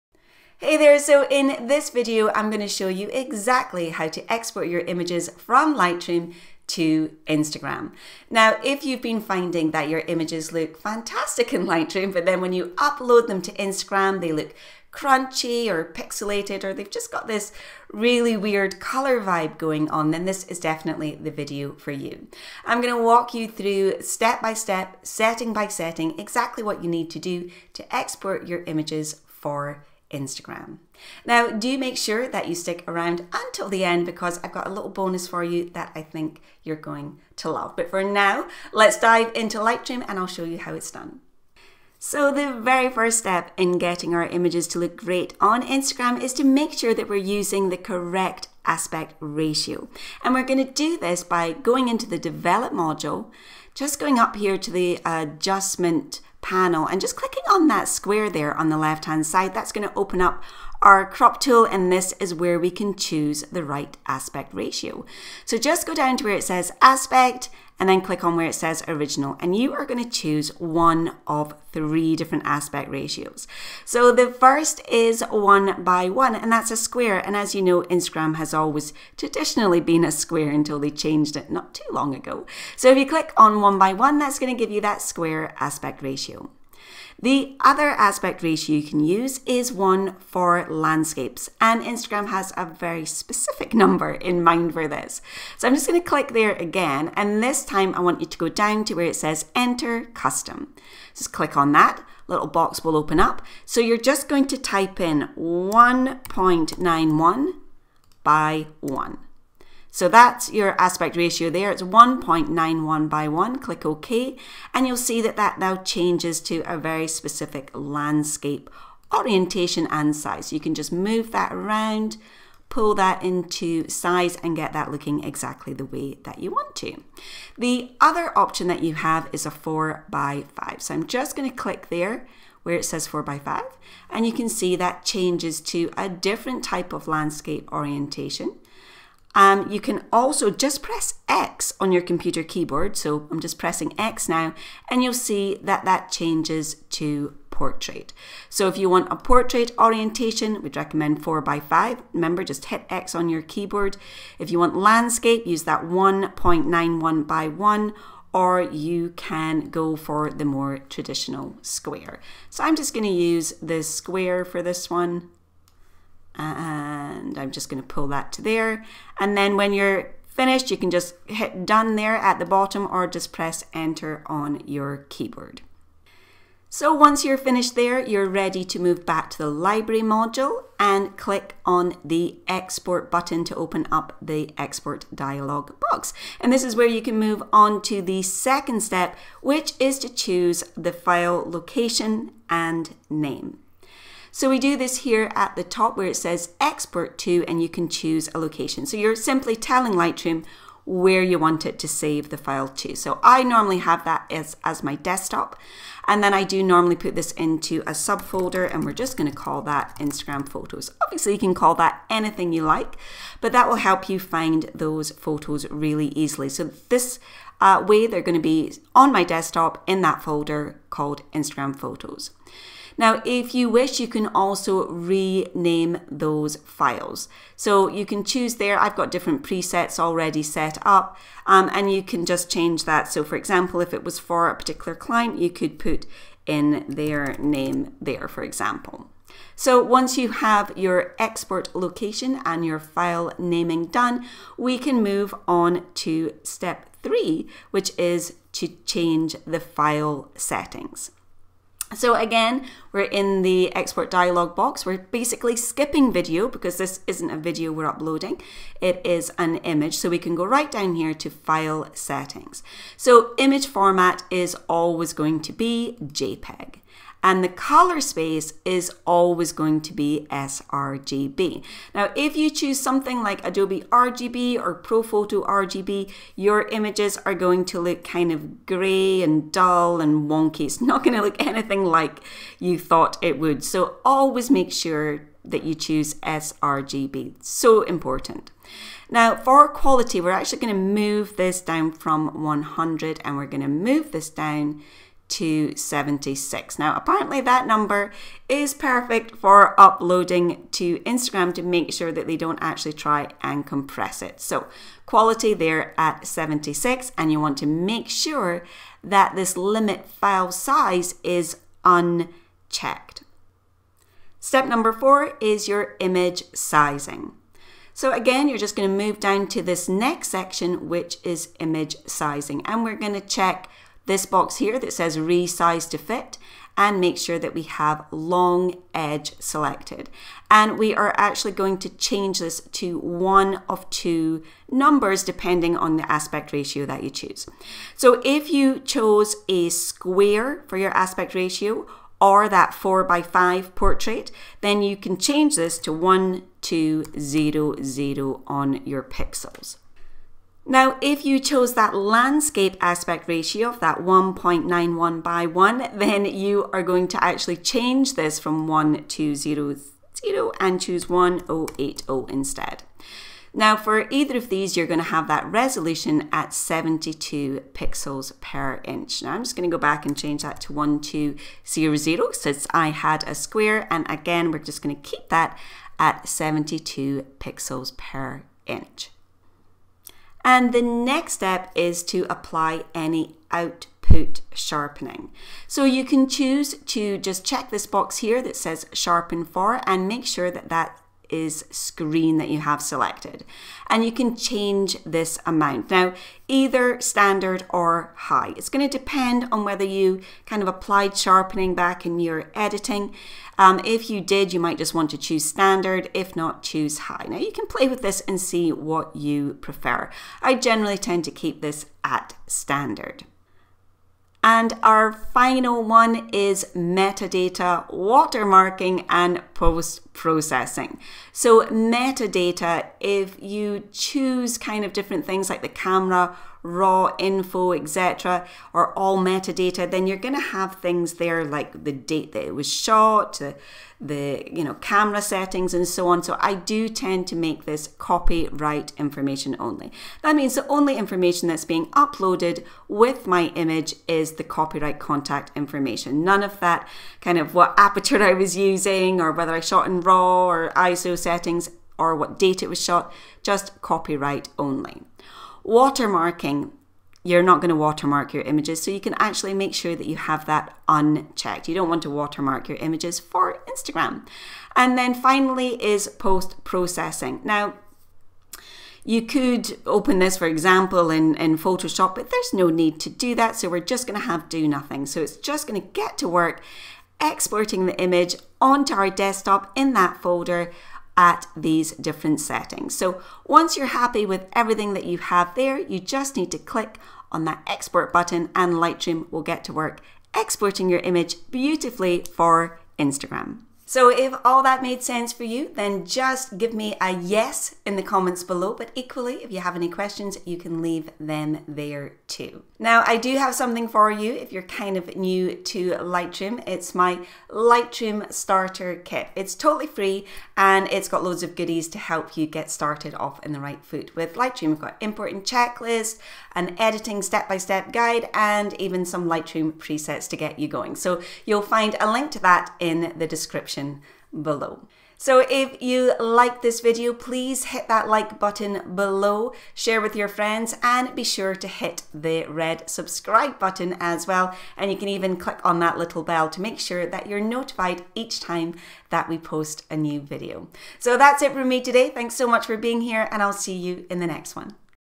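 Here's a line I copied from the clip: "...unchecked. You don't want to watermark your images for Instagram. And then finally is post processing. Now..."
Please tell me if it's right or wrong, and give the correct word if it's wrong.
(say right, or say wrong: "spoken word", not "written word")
right.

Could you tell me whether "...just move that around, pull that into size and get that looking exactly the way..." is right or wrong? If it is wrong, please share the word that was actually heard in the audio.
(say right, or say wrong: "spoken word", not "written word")
right.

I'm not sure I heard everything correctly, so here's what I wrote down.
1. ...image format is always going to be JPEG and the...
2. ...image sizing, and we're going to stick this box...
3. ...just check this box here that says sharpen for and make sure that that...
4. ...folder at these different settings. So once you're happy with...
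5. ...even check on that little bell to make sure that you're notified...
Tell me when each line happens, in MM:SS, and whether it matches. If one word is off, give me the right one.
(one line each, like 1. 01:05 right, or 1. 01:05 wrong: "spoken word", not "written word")
1. 04:23 right
2. 05:21 wrong: "check", not "stick"
3. 06:27 right
4. 08:00 right
5. 08:55 wrong: "click", not "check".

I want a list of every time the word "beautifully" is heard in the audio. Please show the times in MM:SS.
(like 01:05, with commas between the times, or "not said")
08:11.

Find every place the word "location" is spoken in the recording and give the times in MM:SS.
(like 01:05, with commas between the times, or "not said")
03:11, 03:18, 04:01.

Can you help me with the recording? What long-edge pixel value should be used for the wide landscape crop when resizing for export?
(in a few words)
1080.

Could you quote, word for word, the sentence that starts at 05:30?
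And we are actually going to change this to one of two numbers depending on the aspect ratio that you choose.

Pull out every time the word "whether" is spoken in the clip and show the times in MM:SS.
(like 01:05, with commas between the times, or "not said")
06:39, 07:29.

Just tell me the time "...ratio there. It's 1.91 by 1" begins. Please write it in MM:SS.
01:51.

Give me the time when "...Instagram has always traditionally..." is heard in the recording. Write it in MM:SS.
01:17.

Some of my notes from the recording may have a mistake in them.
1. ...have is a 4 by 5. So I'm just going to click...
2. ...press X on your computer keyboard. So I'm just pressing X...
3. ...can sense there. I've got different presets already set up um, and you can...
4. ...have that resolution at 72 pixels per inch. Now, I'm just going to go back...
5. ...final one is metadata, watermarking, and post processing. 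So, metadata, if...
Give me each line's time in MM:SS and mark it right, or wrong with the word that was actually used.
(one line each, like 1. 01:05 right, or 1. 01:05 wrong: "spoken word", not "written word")
1. 02:08 right
2. 02:20 right
3. 03:48 wrong: "choose", not "sense"
4. 06:05 right
5. 06:55 right.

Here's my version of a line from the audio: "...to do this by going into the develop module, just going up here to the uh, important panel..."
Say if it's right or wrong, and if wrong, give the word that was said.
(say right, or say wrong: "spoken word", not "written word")
wrong: "adjustment", not "important".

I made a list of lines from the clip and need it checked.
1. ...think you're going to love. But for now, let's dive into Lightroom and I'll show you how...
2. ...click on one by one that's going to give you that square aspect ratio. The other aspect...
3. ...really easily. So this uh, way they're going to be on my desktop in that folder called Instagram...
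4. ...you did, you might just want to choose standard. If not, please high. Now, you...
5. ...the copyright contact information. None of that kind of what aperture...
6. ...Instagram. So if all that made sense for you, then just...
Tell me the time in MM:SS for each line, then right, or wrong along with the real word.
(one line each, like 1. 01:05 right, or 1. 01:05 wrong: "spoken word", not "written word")
1. 00:36 right
2. 01:23 right
3. 03:35 right
4. 06:44 wrong: "choose", not "please"
5. 07:24 right
6. 08:12 right.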